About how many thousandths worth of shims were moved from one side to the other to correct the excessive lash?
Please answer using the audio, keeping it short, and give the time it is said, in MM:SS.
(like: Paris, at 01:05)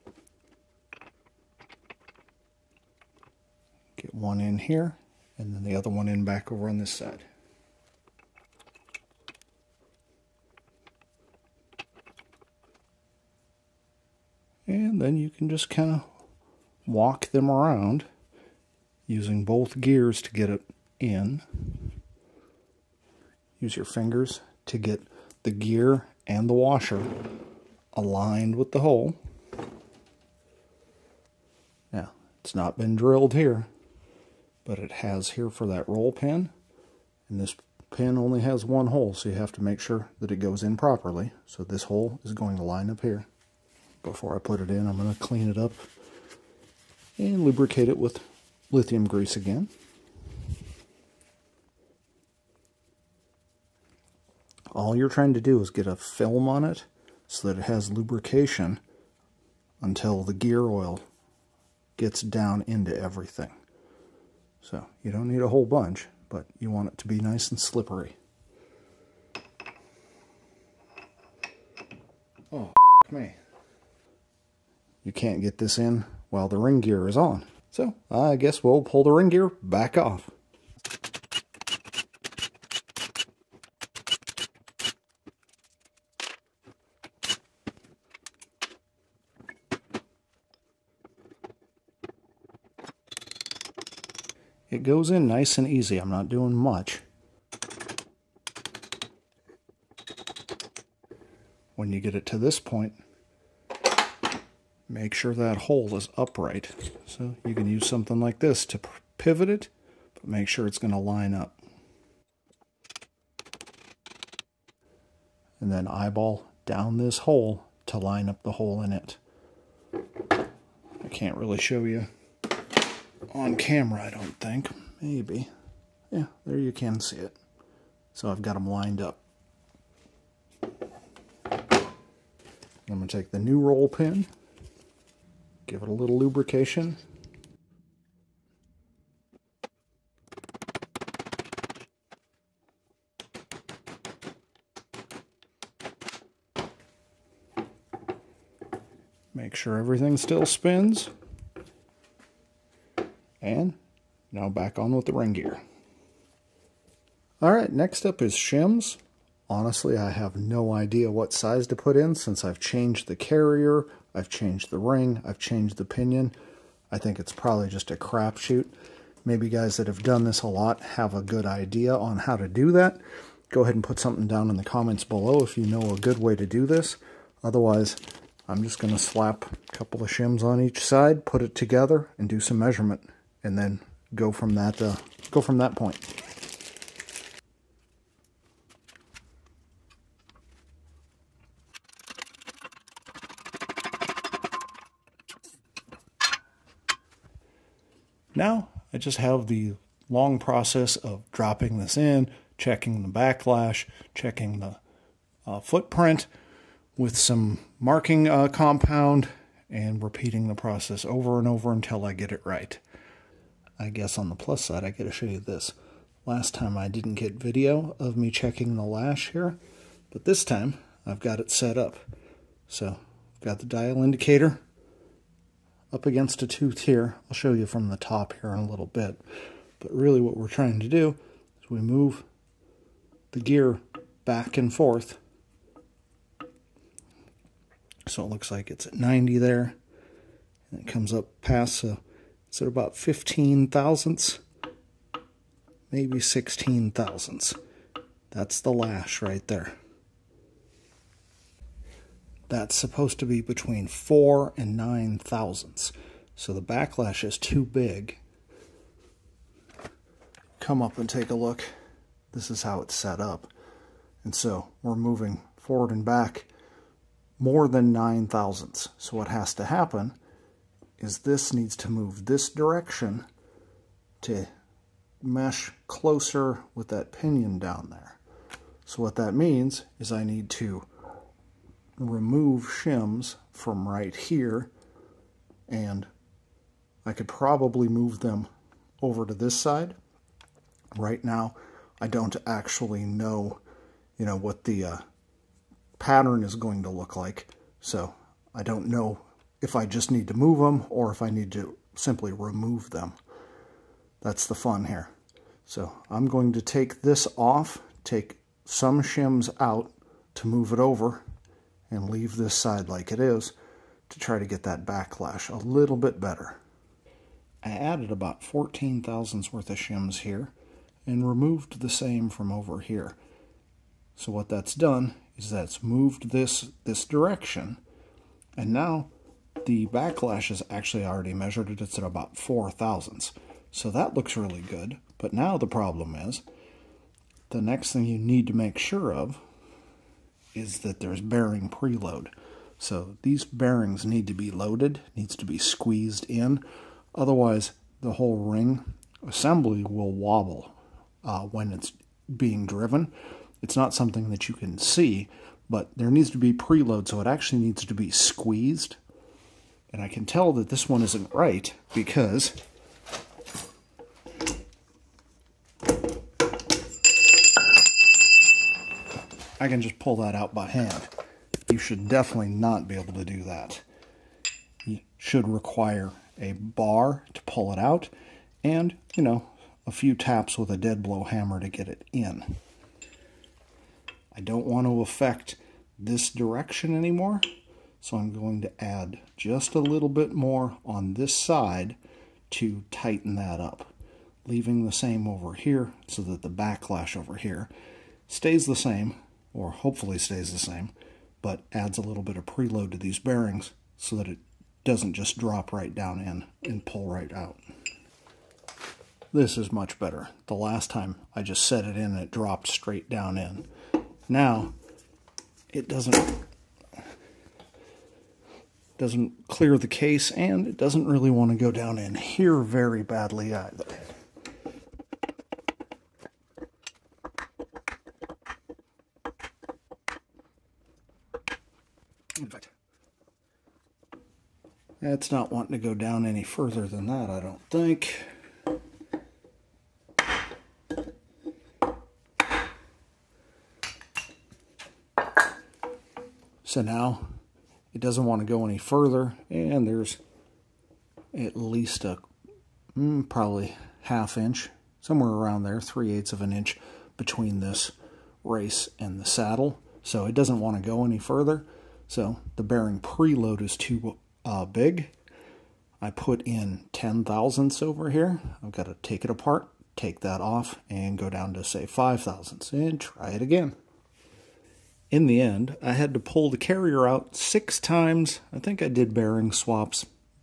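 14, at 05:18.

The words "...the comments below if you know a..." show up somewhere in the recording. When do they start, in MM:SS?
02:54.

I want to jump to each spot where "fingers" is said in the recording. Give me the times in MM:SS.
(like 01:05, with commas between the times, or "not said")
00:23.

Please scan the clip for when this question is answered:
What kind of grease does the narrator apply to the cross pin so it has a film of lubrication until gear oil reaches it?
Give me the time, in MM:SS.
00:48.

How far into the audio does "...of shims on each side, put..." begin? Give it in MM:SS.
03:00.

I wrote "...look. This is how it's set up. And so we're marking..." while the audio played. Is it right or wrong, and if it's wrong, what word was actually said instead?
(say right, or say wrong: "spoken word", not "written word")
wrong: "moving", not "marking".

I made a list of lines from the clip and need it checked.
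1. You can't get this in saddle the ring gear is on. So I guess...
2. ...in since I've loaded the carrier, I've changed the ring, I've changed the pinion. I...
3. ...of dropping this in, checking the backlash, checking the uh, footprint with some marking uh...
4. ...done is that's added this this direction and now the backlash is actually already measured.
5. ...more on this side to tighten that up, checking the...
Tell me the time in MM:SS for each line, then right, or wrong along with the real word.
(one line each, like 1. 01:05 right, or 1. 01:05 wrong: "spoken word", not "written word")
1. 01:15 wrong: "while", not "saddle"
2. 02:41 wrong: "changed", not "loaded"
3. 03:20 right
4. 05:24 wrong: "moved", not "added"
5. 06:30 wrong: "leaving", not "checking".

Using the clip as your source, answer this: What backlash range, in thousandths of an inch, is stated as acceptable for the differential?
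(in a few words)
4 to 9.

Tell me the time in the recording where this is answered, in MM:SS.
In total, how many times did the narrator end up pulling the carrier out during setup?
07:57.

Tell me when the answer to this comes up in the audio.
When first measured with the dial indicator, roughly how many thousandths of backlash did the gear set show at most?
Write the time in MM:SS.
04:06.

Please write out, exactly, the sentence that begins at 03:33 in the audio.
I guess on the plus side, I gotta show you this.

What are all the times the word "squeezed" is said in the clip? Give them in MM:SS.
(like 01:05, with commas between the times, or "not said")
05:45, 05:58.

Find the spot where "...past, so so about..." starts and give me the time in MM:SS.
04:01.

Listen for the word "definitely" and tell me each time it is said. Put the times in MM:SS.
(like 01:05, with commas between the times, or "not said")
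06:12.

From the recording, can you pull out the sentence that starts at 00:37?
And this pin only has one hole, so you have to make sure that it goes in properly.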